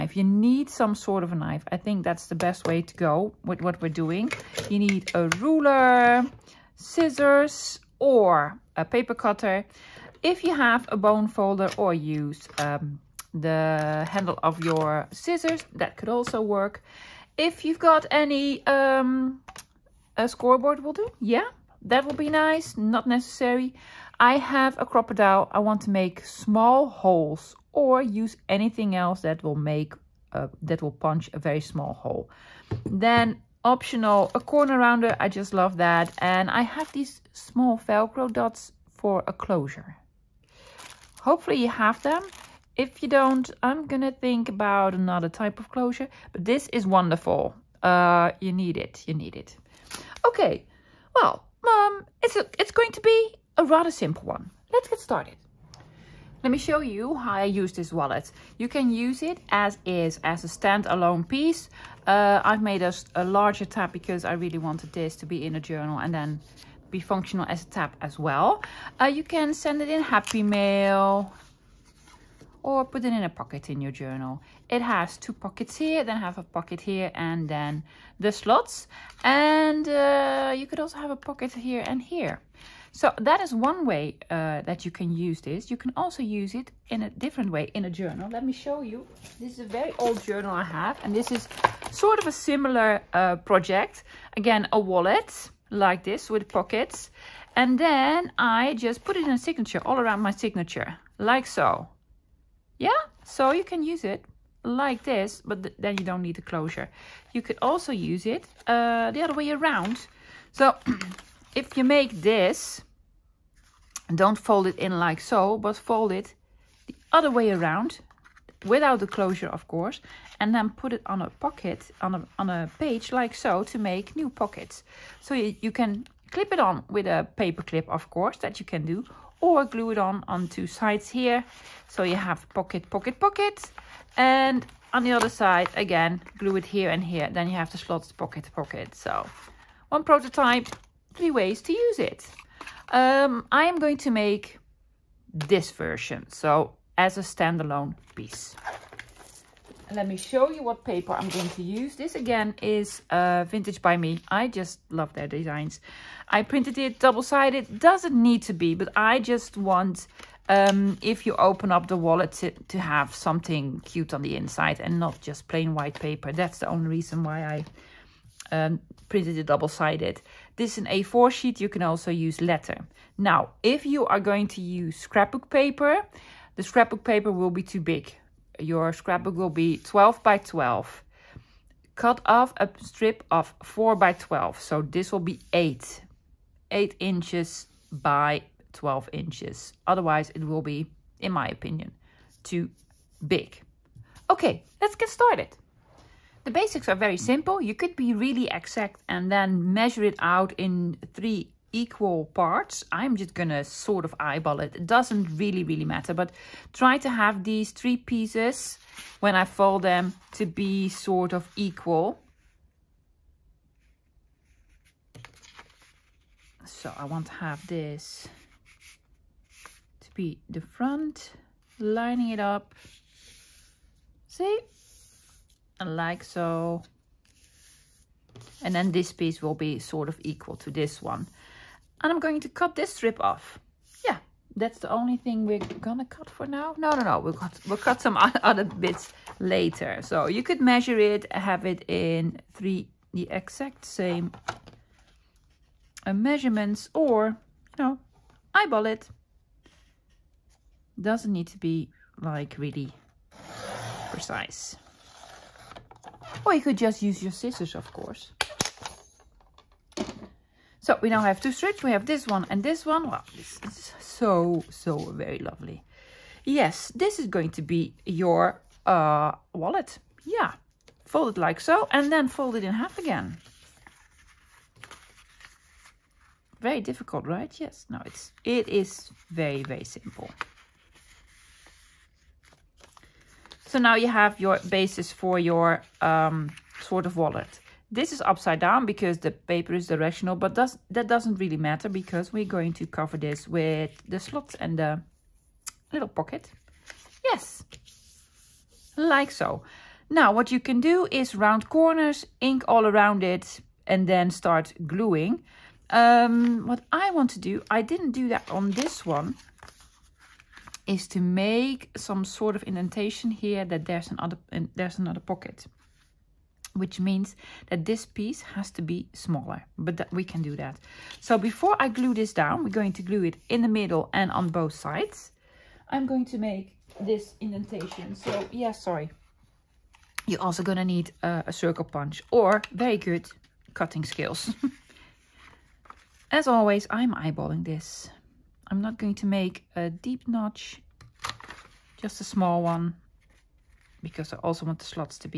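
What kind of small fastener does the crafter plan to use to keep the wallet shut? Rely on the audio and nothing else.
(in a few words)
Velcro dots.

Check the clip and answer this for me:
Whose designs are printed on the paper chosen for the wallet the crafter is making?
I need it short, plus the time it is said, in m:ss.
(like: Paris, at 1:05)
Vintage by Me, at 2:33.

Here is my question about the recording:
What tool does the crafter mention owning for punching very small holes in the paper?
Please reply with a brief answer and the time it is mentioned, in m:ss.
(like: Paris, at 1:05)
Crop-A-Dile, at 0:24.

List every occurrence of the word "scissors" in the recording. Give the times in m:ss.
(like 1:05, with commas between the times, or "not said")
0:06, 0:15, 4:17.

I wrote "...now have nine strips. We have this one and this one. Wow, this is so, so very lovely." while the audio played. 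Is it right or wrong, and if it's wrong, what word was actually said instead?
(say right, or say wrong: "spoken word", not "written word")
wrong: "two", not "nine".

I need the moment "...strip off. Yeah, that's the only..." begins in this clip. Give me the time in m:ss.
3:52.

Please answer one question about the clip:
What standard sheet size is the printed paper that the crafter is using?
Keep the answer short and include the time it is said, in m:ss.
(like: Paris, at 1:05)
A4, at 2:50.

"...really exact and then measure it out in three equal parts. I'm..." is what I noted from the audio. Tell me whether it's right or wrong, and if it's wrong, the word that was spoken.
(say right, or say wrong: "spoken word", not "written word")
right.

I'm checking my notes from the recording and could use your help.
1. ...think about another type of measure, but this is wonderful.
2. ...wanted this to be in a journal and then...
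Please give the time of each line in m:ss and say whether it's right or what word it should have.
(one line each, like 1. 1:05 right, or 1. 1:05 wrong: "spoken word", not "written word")
1. 0:44 wrong: "closure", not "measure"
2. 1:04 right.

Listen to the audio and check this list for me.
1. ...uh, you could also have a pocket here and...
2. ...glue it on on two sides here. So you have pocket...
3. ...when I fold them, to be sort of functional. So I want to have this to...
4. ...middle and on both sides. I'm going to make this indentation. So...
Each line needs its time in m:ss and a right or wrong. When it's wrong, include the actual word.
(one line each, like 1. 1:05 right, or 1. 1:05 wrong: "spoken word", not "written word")
1. 1:19 right
2. 2:09 right
3. 3:29 wrong: "equal", not "functional"
4. 5:23 right.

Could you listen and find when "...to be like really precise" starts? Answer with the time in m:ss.
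4:11.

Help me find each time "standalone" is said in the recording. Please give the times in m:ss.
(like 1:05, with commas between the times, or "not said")
1:00, 2:27.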